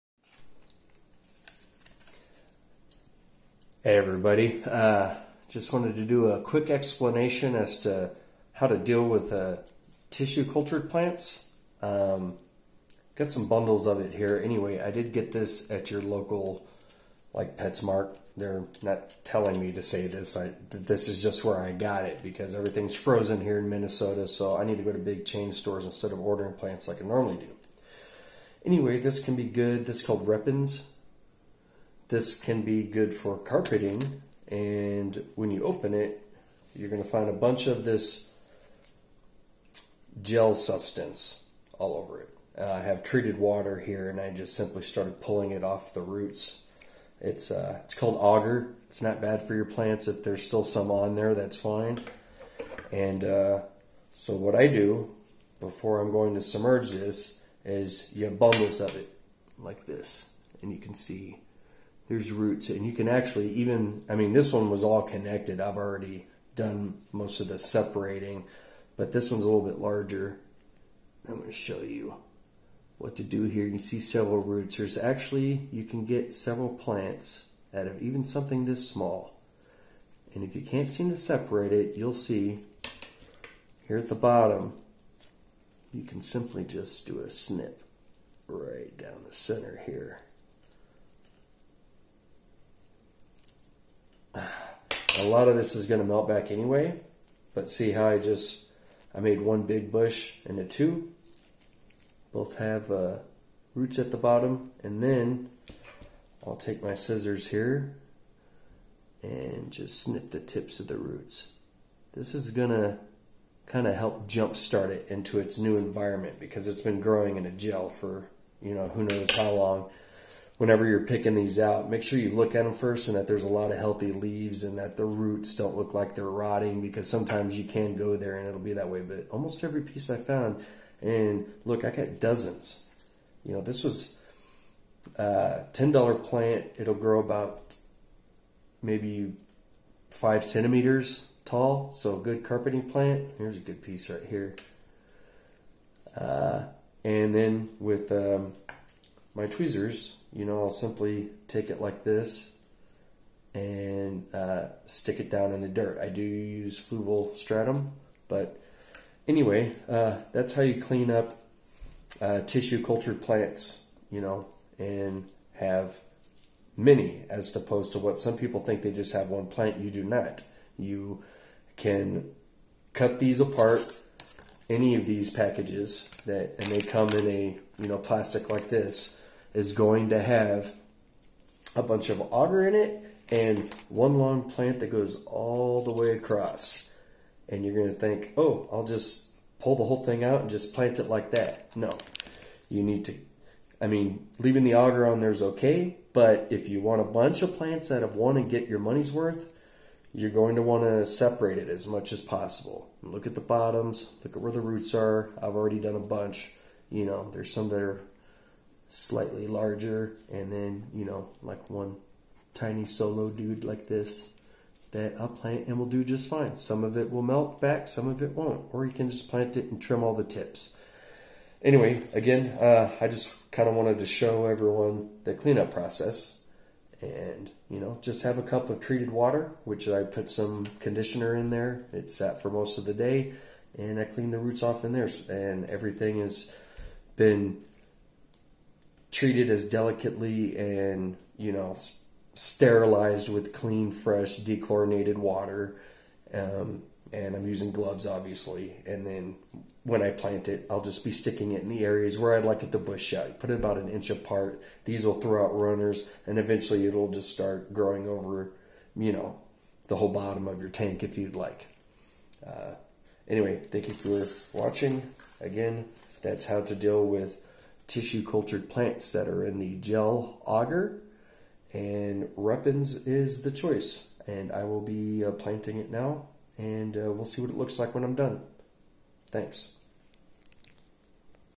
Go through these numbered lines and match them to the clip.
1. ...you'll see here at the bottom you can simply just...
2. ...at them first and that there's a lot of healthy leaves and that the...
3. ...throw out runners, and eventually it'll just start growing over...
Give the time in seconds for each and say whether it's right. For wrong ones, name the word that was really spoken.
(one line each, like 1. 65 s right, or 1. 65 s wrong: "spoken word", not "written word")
1. 81 s right
2. 122 s right
3. 255 s right.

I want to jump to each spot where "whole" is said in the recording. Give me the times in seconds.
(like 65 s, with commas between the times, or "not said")
189 s, 259 s.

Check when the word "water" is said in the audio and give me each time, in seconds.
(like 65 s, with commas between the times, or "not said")
43 s, 229 s, 245 s.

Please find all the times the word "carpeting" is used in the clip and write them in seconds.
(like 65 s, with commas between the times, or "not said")
33 s, 142 s.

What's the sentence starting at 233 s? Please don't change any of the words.
And I cleaned the roots off in there.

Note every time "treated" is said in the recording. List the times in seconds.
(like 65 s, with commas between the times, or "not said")
43 s, 228 s, 239 s.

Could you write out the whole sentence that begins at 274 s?
And I will be uh, planting it now, and uh, we'll see what it looks like when I'm done.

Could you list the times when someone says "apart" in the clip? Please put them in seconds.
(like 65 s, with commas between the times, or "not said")
173 s, 254 s.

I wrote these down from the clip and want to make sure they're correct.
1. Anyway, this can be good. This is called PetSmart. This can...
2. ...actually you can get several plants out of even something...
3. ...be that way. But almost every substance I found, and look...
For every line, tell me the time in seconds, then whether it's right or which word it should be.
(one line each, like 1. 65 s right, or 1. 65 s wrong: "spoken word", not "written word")
1. 28 s wrong: "Repens", not "PetSmart"
2. 74 s right
3. 128 s wrong: "piece", not "substance".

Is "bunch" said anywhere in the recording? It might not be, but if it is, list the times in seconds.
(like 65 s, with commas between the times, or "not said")
37 s, 181 s, 197 s, 205 s.